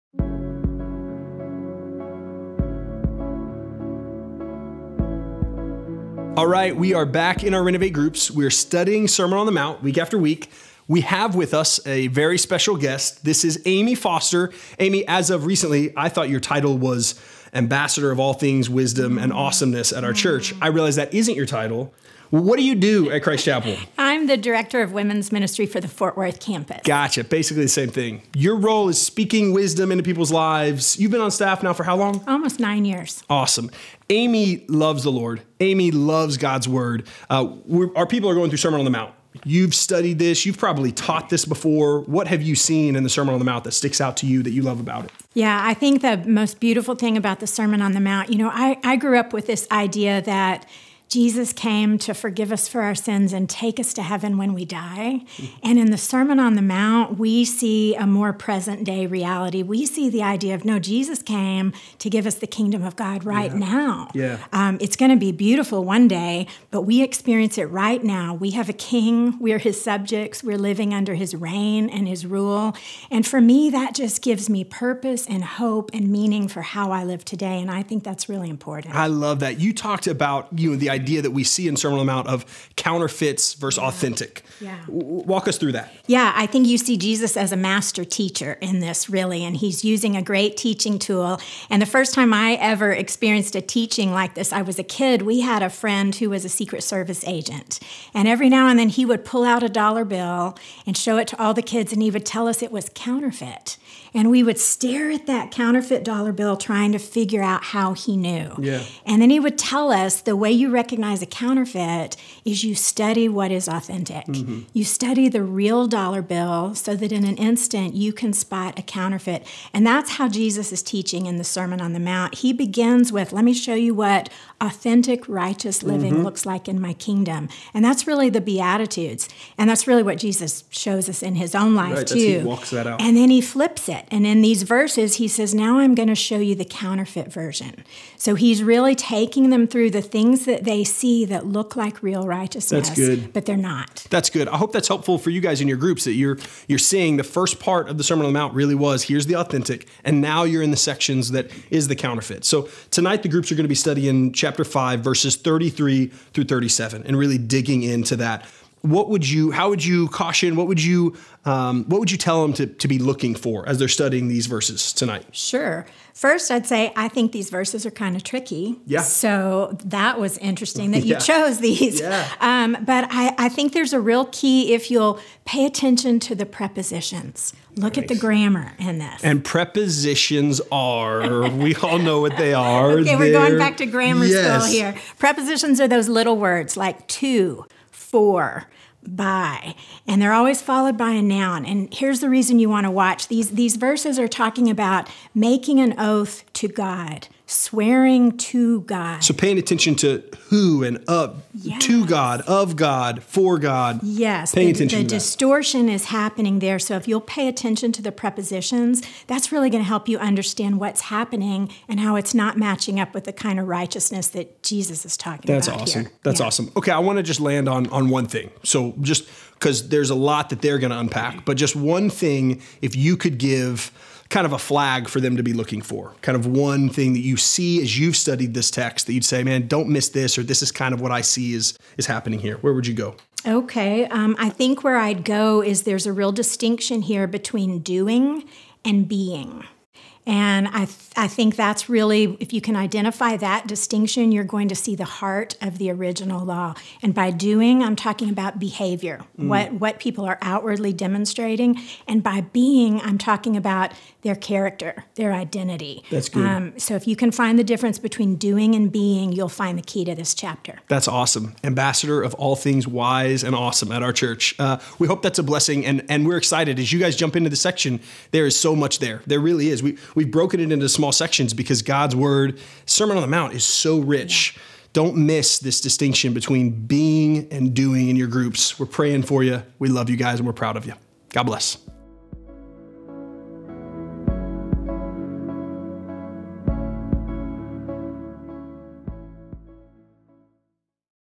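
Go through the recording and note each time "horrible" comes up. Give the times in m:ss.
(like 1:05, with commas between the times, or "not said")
not said.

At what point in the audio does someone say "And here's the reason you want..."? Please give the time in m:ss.
3:11.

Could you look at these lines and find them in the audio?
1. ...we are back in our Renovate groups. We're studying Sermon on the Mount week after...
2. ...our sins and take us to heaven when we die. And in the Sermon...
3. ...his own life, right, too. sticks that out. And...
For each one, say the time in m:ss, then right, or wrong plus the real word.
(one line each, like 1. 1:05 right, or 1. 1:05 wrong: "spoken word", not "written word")
1. 0:06 right
2. 0:52 right
3. 2:11 wrong: "walks", not "sticks".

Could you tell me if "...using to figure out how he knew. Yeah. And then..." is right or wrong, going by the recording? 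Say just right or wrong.
wrong.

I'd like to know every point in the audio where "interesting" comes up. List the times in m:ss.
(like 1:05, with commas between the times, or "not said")
2:50.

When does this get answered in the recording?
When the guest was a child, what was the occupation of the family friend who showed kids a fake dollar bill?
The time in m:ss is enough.
1:36.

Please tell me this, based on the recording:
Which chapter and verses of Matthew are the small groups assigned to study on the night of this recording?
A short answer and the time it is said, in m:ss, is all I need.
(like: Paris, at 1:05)
Chapter 5, verses 33-37, at 2:34.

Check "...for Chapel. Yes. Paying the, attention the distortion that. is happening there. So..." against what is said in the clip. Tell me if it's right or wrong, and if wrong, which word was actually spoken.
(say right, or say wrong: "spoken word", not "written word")
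wrong: "God", not "Chapel".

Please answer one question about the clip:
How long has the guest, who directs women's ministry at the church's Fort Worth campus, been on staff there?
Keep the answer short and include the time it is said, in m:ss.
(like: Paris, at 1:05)
Almost 9 years, at 0:32.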